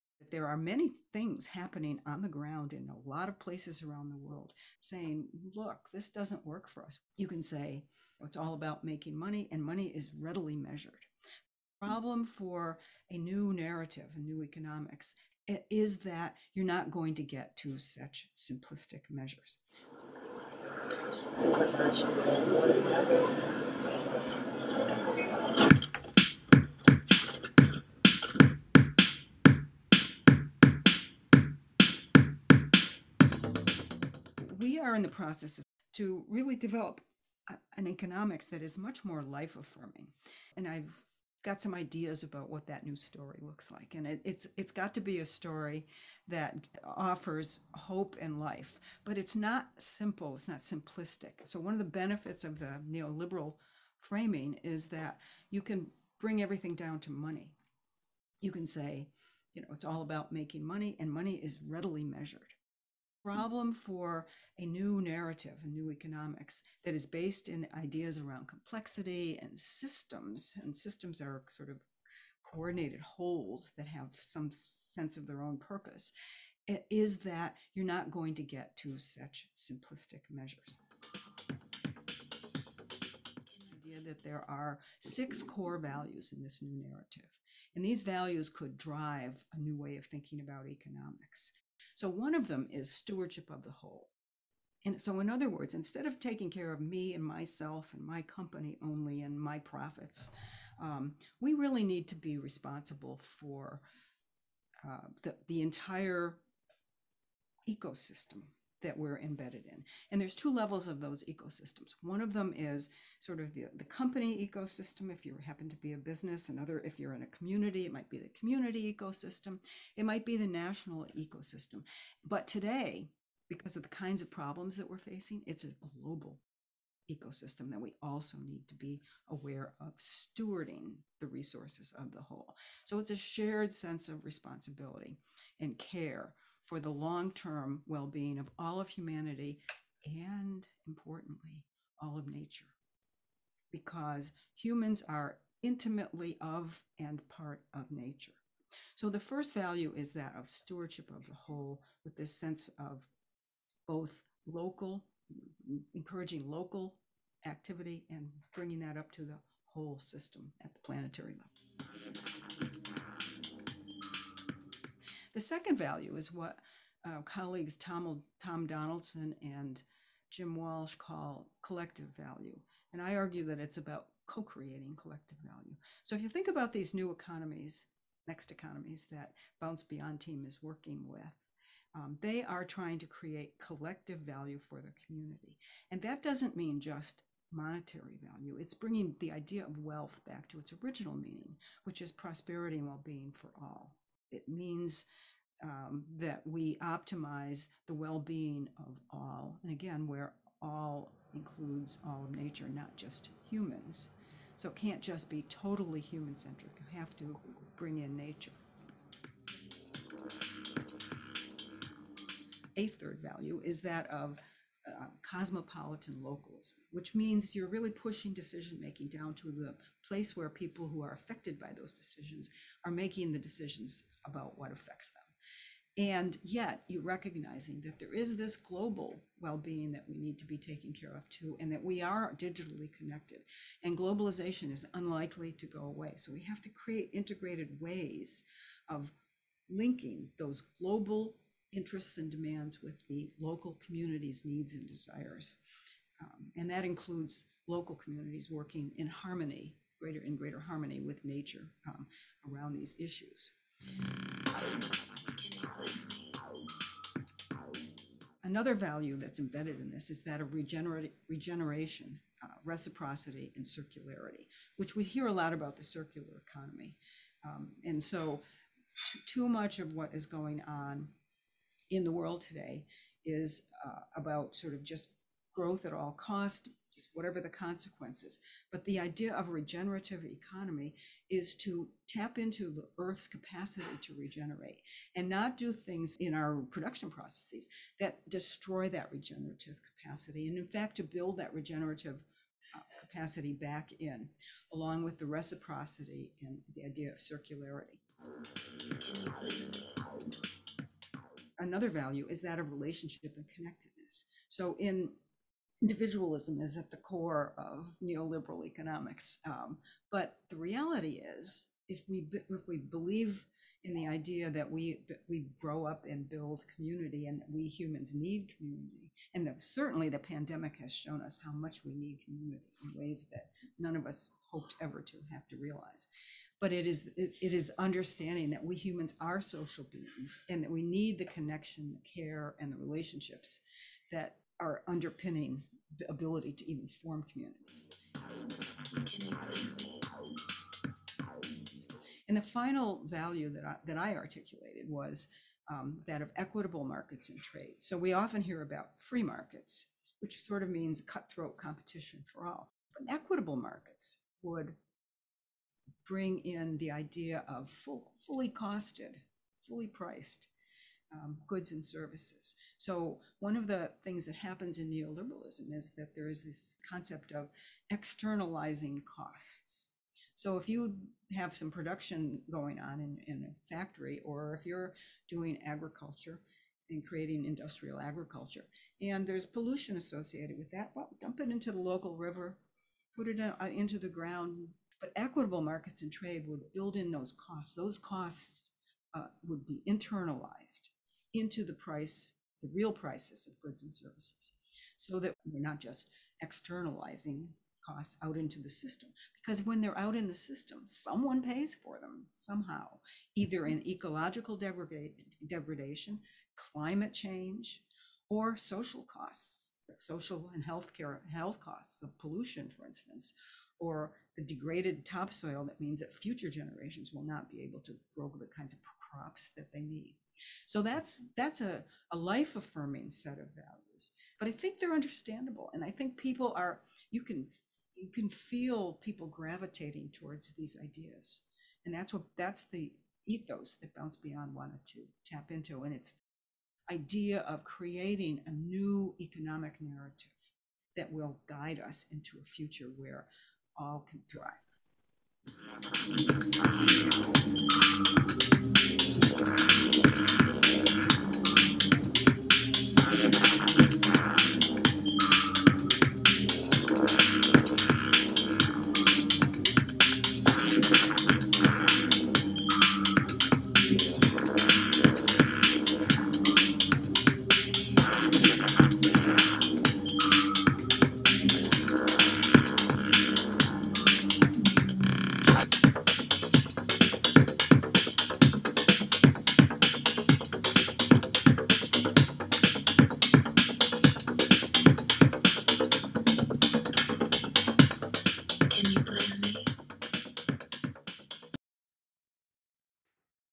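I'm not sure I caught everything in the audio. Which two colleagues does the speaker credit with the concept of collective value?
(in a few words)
Tom Donaldson and Jim Walsh.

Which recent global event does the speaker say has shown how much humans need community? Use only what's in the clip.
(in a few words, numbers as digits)
The pandemic.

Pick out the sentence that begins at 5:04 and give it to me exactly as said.
So in individualism is at the core of neoliberal economics.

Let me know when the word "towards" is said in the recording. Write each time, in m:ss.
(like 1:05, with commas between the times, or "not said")
7:10.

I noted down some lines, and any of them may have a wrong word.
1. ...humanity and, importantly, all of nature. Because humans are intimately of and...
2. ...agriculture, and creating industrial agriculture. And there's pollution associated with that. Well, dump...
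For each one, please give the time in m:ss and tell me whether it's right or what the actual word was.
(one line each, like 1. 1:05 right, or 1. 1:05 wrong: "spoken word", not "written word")
1. 2:18 right
2. 6:15 right.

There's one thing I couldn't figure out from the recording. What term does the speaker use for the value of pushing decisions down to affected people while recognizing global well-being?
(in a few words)
Cosmopolitan localism.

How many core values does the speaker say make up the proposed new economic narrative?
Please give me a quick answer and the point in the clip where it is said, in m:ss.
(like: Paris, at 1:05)
6, at 1:25.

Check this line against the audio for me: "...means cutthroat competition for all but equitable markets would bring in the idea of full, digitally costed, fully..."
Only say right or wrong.
wrong.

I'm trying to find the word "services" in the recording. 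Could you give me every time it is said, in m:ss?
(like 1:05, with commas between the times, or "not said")
6:01, 6:33.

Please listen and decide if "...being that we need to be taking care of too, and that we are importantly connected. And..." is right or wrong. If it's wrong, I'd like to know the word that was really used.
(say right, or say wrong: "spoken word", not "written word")
wrong: "digitally", not "importantly".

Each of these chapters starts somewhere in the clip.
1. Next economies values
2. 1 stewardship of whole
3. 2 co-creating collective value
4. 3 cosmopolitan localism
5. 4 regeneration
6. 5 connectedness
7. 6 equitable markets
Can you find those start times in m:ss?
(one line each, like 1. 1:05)
1. 0:35
2. 1:23
3. 2:45
4. 3:32
5. 4:18
6. 5:01
7. 5:42.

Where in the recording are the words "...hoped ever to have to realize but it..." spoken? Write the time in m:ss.
5:24.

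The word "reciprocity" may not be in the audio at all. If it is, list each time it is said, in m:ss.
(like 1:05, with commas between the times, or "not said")
4:22, 4:55.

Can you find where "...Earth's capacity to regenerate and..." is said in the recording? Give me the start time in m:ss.
4:42.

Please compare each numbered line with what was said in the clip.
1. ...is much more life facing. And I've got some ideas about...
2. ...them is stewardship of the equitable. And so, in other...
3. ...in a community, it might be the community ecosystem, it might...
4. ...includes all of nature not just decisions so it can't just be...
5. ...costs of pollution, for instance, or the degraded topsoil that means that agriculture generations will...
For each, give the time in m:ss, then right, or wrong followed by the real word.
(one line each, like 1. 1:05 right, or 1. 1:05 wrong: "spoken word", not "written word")
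1. 0:38 wrong: "affirming", not "facing"
2. 1:32 wrong: "whole", not "equitable"
3. 1:57 right
4. 3:21 wrong: "humans", not "decisions"
5. 6:51 wrong: "future", not "agriculture".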